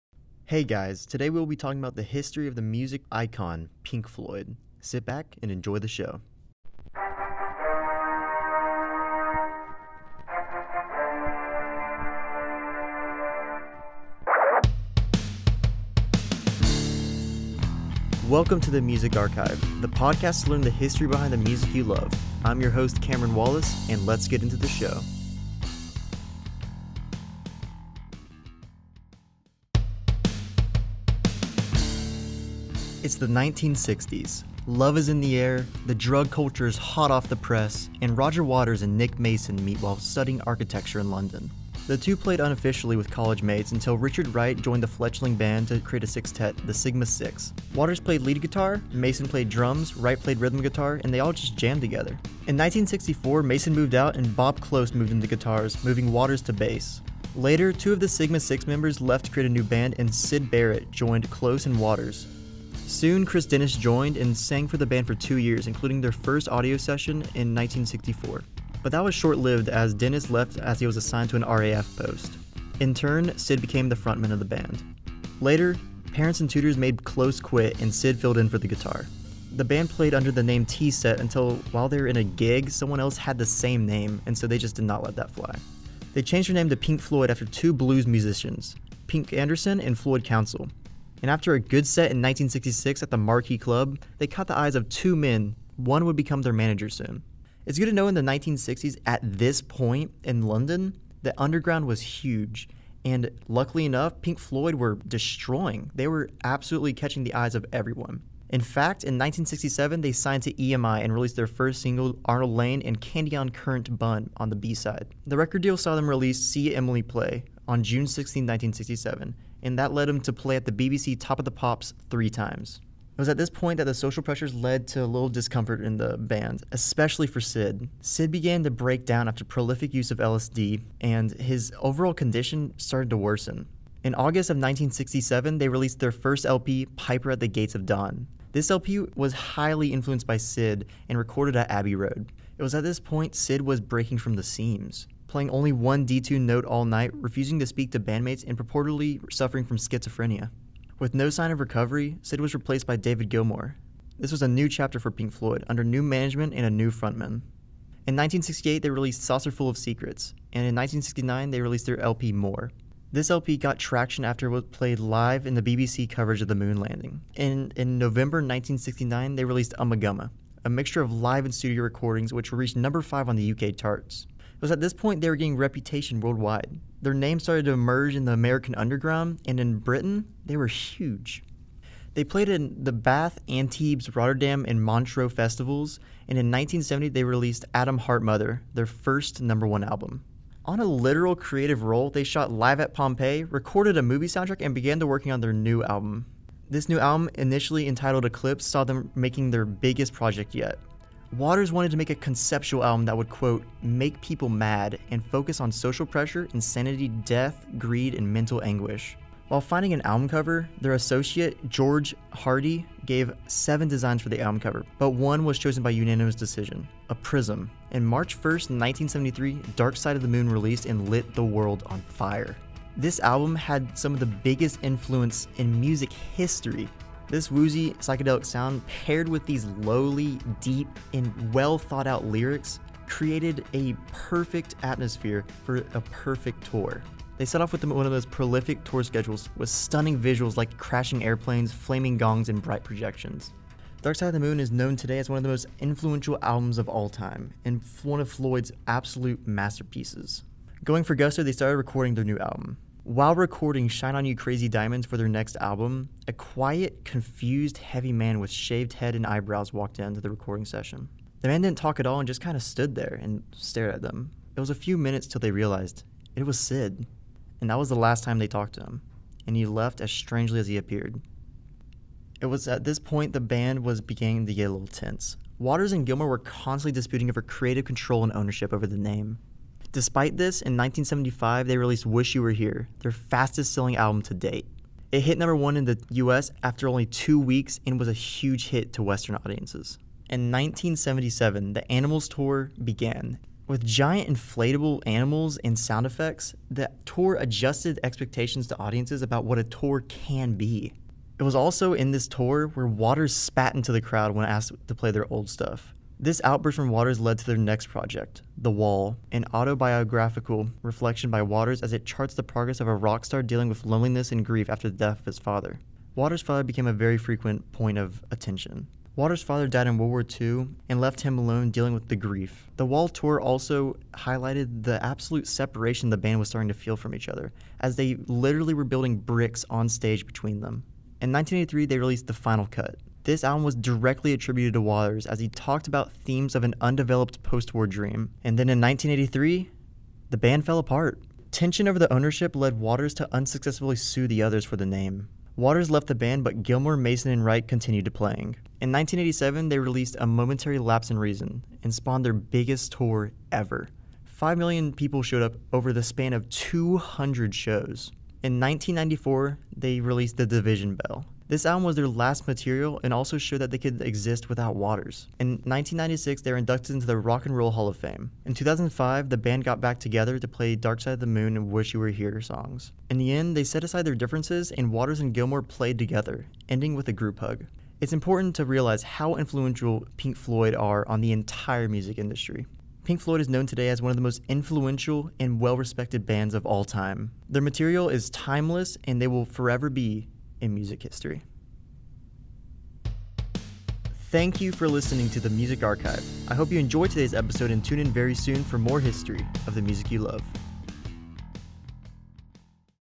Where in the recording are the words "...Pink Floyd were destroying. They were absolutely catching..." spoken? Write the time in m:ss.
1:44.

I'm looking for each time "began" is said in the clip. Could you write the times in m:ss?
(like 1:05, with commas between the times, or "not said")
2:08, 3:14, 4:52.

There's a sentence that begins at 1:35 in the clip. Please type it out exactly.
One would become their manager soon.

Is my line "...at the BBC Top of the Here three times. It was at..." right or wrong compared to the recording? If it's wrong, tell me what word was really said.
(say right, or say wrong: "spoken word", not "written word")
wrong: "Pops", not "Here".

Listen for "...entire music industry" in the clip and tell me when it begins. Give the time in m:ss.
6:21.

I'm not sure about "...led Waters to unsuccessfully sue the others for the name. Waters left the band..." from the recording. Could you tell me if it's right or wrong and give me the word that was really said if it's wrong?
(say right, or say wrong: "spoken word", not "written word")
right.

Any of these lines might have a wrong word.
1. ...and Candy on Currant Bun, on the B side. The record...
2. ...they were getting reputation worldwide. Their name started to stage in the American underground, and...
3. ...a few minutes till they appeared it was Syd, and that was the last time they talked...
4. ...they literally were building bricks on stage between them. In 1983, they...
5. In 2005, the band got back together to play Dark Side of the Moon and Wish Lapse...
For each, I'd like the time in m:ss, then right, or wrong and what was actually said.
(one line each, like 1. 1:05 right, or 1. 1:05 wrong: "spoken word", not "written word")
1. 1:52 right
2. 2:55 wrong: "emerge", not "stage"
3. 4:24 wrong: "realized", not "appeared"
4. 5:27 right
5. 6:08 wrong: "You", not "Lapse".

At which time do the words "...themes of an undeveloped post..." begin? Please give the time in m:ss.
5:36.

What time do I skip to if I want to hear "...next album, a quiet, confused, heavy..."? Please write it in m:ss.
4:15.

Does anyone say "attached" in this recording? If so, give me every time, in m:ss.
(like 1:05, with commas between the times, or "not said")
not said.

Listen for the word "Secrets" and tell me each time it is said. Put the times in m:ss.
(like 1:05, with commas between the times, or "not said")
2:39.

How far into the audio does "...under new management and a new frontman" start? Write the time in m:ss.
2:35.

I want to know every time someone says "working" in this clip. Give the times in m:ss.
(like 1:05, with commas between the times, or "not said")
3:15.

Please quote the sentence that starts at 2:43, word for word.
This LP got traction after it was played live in the BBC coverage of the moon landing.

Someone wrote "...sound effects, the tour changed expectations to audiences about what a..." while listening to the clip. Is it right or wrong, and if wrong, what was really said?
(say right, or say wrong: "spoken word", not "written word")
wrong: "adjusted", not "changed".